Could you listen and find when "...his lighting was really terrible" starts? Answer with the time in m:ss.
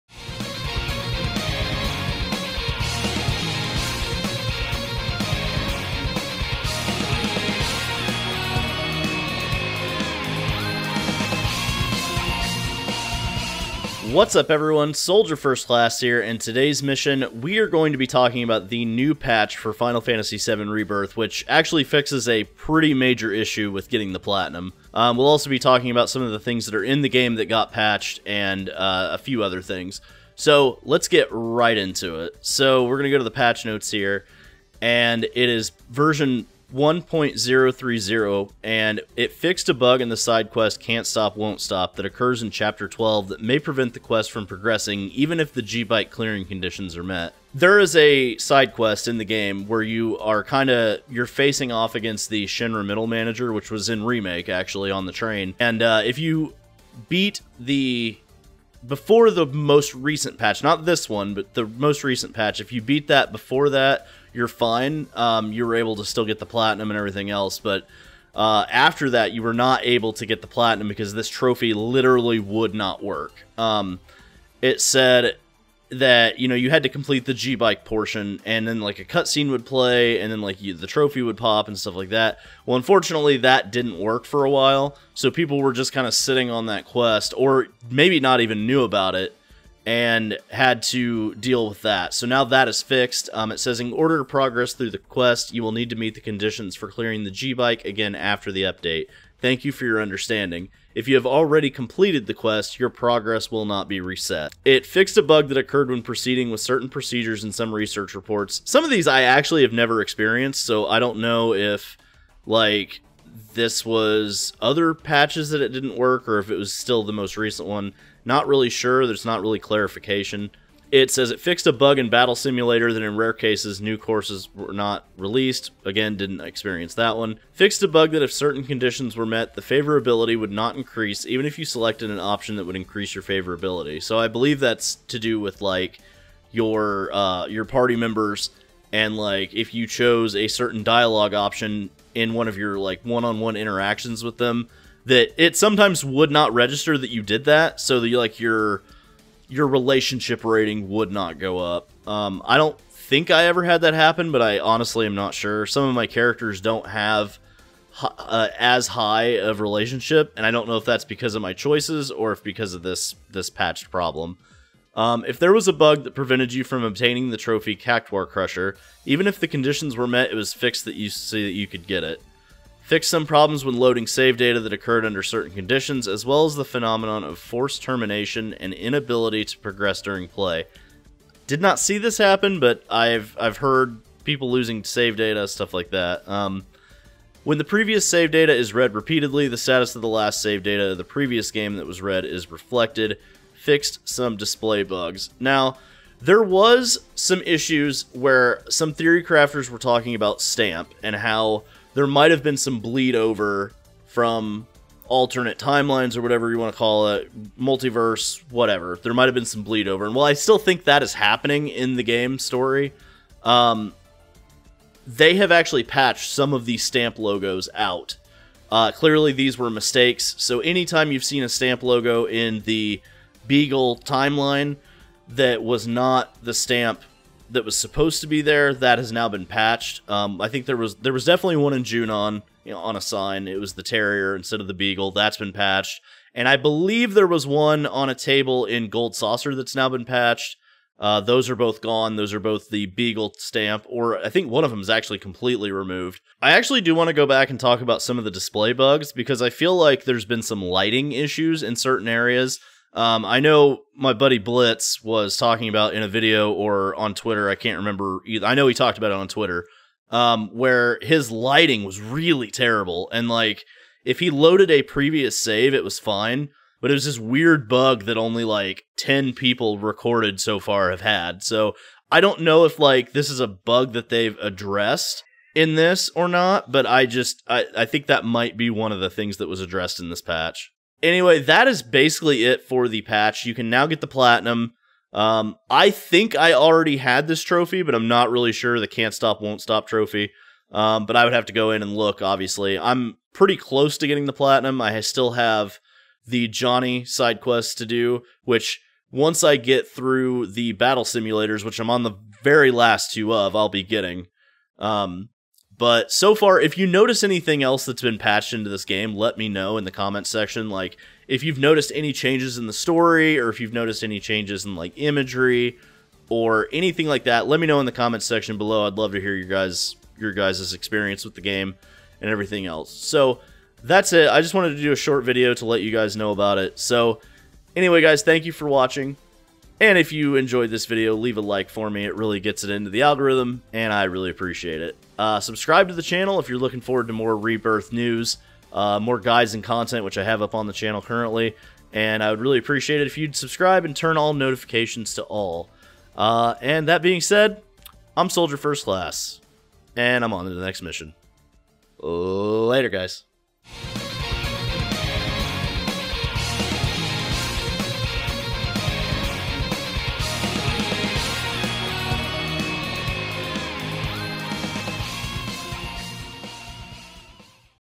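4:21.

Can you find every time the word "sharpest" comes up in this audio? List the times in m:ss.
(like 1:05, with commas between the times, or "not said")
not said.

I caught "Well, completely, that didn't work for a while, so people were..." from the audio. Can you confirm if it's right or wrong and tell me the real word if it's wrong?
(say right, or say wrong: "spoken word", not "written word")
wrong: "unfortunately", not "completely".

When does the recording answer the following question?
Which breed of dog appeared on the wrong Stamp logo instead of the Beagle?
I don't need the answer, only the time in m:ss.
3:53.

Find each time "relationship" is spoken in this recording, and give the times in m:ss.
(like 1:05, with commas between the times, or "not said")
2:29, 2:39.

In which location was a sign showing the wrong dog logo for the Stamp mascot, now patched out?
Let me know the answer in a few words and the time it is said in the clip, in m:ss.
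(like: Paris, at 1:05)
Junon, at 3:51.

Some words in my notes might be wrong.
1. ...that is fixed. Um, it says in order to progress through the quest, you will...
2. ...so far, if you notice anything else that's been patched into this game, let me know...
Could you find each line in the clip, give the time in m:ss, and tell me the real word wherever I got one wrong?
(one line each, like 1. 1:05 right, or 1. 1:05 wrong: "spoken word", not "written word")
1. 1:32 right
2. 5:06 right.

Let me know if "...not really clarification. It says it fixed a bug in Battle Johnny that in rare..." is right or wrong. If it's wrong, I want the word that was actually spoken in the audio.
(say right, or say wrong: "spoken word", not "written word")
wrong: "Simulator", not "Johnny".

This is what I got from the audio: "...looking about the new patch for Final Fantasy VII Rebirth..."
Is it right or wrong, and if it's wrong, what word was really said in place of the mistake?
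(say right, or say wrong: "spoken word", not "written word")
wrong: "talking", not "looking".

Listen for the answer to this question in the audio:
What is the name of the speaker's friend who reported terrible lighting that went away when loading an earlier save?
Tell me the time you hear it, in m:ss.
4:14.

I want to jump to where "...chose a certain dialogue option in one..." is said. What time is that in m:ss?
2:19.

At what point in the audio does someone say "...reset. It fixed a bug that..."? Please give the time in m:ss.
1:44.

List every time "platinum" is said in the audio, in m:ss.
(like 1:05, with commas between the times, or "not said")
0:24, 1:06, 1:10, 4:44, 4:54.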